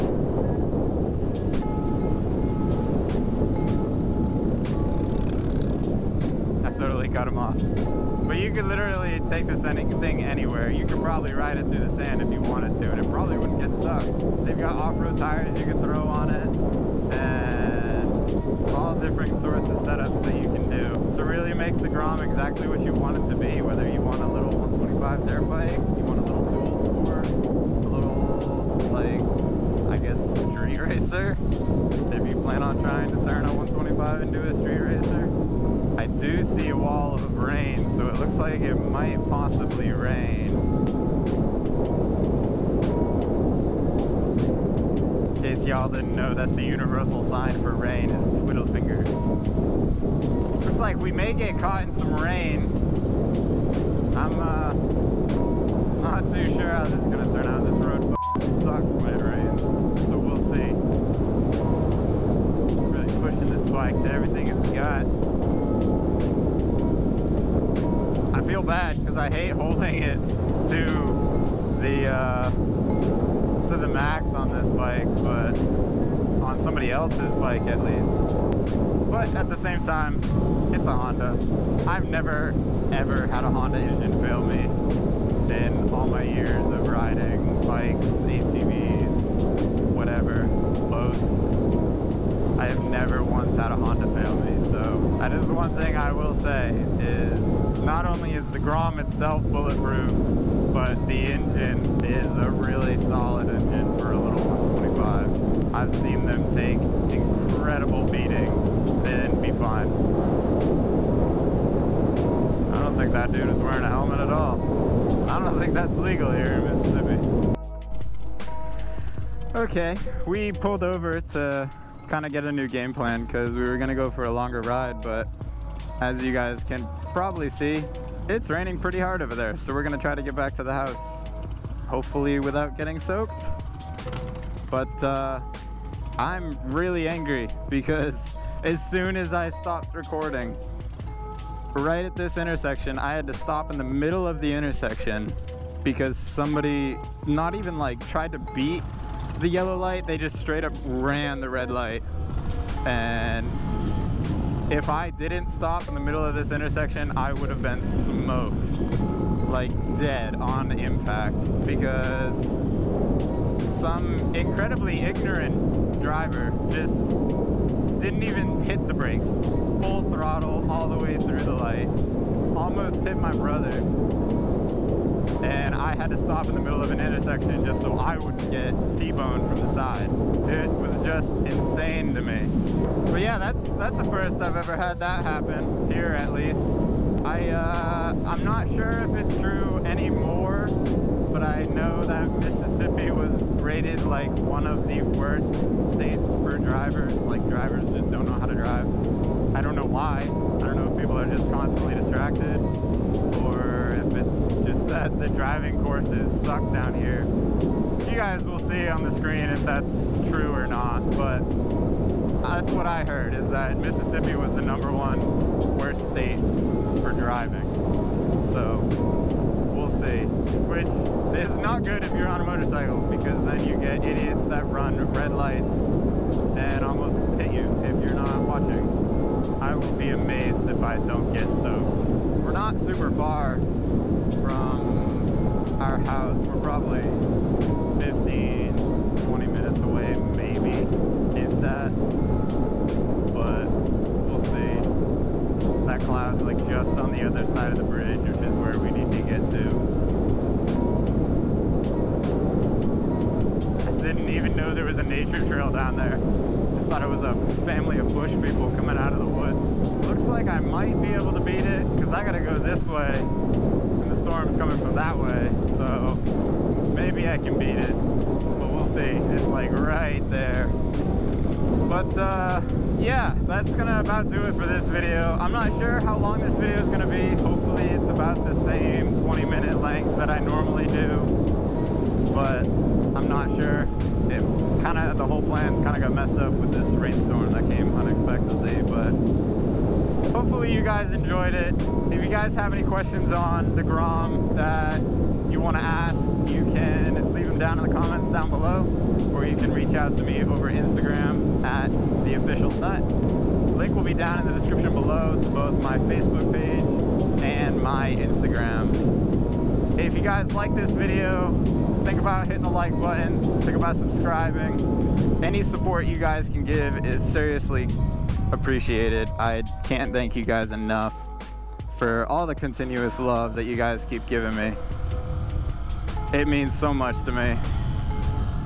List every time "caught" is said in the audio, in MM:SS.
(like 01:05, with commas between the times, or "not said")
00:51.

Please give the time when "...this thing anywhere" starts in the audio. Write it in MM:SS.
00:09.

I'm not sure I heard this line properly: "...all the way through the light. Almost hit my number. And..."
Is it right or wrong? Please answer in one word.
wrong.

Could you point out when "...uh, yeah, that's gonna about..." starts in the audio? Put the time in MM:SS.
04:32.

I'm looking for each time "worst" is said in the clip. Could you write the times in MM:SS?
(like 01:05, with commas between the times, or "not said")
03:15, 03:35.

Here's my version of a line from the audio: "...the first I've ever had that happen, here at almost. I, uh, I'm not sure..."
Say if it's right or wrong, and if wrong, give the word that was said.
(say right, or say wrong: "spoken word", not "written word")
wrong: "least", not "almost".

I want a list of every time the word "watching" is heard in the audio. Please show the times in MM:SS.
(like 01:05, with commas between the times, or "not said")
03:48.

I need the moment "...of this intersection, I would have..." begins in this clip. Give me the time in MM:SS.
02:36.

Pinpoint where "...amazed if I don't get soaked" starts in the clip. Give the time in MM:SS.
03:50.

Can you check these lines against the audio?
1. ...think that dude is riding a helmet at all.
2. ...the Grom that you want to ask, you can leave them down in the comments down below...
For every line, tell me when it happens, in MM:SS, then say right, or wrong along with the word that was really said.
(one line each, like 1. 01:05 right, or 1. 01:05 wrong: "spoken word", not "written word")
1. 01:52 wrong: "wearing", not "riding"
2. 04:53 right.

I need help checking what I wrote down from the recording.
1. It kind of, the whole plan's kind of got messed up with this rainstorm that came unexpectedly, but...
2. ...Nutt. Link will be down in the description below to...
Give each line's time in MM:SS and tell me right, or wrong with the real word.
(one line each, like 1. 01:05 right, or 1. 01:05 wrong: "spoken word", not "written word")
1. 04:44 right
2. 05:02 right.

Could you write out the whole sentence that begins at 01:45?
I've seen them take incredible beatings and be fine.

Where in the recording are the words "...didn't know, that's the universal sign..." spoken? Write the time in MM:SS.
00:45.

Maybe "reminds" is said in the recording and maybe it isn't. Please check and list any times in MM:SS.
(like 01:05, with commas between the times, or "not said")
not said.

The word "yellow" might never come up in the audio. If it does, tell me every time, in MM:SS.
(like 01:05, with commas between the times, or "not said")
02:29.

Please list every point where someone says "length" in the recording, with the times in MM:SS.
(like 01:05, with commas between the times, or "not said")
04:39.